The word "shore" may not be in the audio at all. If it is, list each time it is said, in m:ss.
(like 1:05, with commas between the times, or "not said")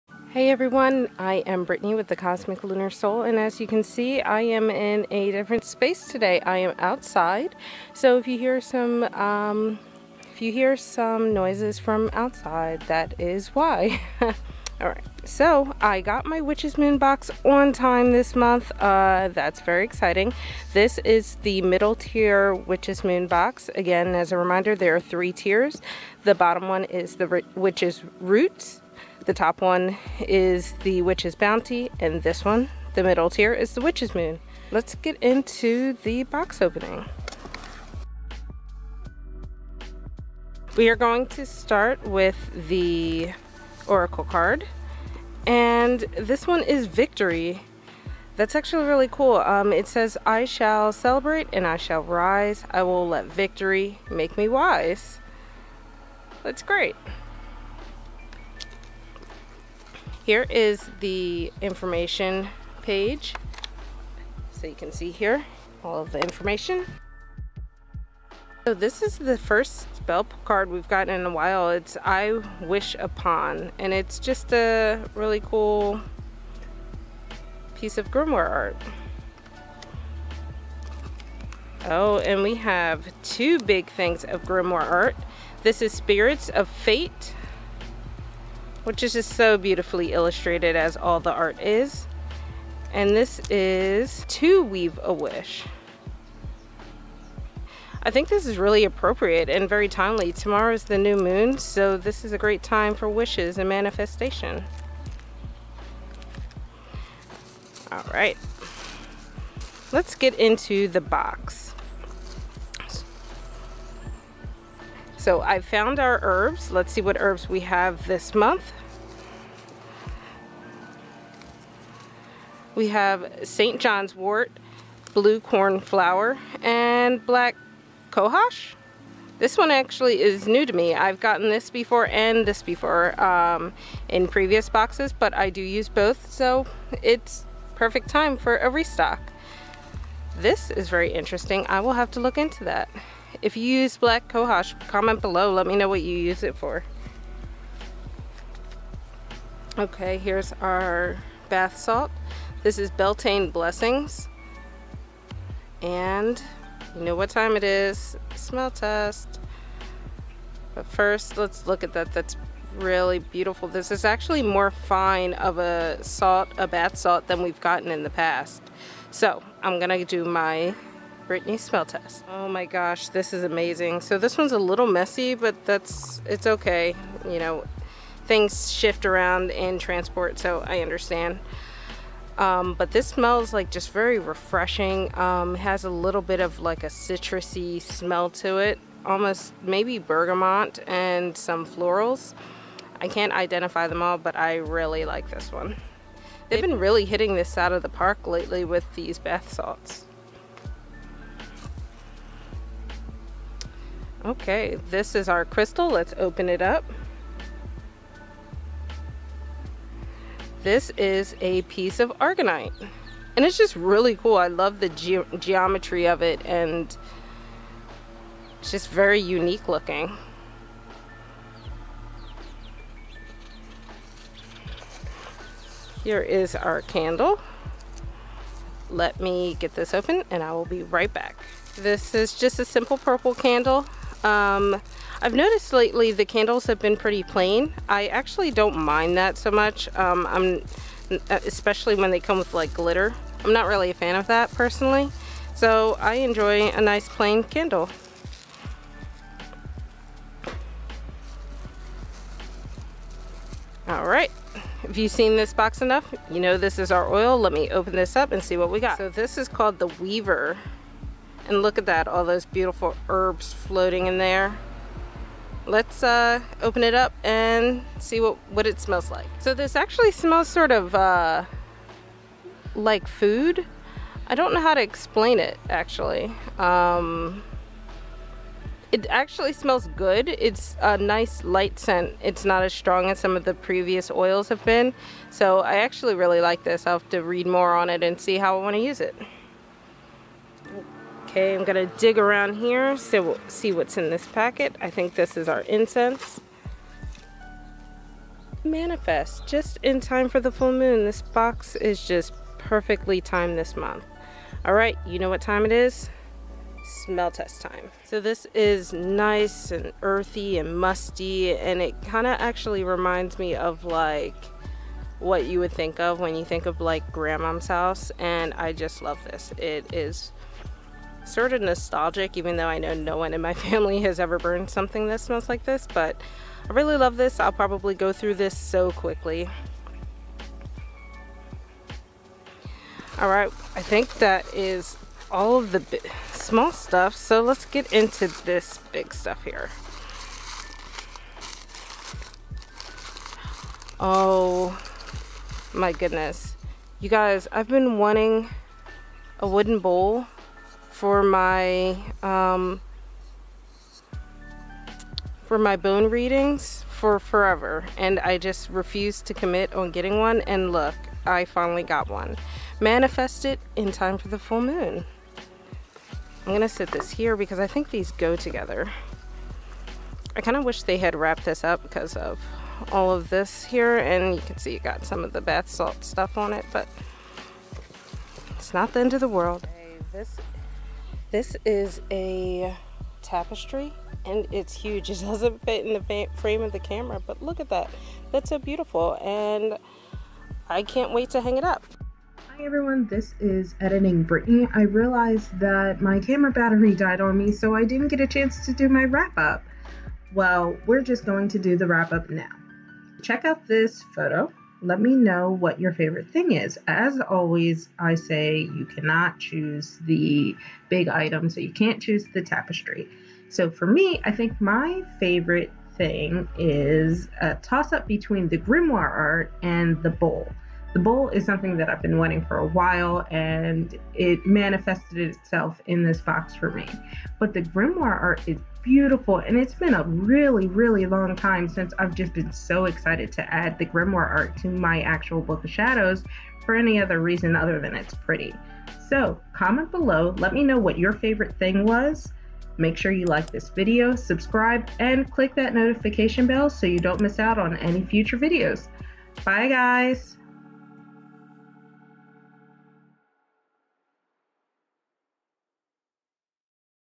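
not said.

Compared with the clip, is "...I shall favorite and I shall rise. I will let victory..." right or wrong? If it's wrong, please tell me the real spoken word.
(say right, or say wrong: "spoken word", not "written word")
wrong: "celebrate", not "favorite".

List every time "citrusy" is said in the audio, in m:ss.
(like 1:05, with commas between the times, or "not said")
3:06.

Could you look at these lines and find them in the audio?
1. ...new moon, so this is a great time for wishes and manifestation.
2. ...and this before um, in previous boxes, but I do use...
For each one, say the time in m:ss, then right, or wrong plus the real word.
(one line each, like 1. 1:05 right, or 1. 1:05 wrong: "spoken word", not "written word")
1. 1:40 right
2. 2:12 right.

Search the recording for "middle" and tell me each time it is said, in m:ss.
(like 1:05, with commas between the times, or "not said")
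0:21, 0:33.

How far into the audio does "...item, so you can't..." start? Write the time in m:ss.
6:51.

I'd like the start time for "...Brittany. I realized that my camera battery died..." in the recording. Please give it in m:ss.
6:34.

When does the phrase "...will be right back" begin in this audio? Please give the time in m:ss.
3:50.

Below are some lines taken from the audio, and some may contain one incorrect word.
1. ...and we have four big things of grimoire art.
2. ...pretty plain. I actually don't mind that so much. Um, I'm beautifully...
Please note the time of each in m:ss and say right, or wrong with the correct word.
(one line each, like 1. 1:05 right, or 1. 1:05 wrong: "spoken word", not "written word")
1. 1:22 wrong: "two", not "four"
2. 3:56 wrong: "especially", not "beautifully".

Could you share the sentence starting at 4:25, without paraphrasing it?
Let's uh, open it up and see what, what it smells like.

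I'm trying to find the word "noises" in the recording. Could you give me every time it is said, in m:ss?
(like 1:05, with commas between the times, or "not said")
0:11.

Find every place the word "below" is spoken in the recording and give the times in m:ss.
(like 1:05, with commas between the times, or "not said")
2:25, 7:19.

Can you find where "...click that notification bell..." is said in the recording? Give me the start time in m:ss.
7:25.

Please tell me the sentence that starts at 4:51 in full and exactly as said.
Okay, I'm gonna dig around here, so we'll see what's in this packet.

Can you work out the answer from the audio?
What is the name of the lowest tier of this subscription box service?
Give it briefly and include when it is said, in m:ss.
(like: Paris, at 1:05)
Witch's Roots, at 0:27.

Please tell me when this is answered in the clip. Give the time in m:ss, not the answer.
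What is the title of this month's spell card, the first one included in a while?
1:12.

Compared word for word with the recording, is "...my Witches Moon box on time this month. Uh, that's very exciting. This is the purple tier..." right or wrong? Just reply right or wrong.
wrong.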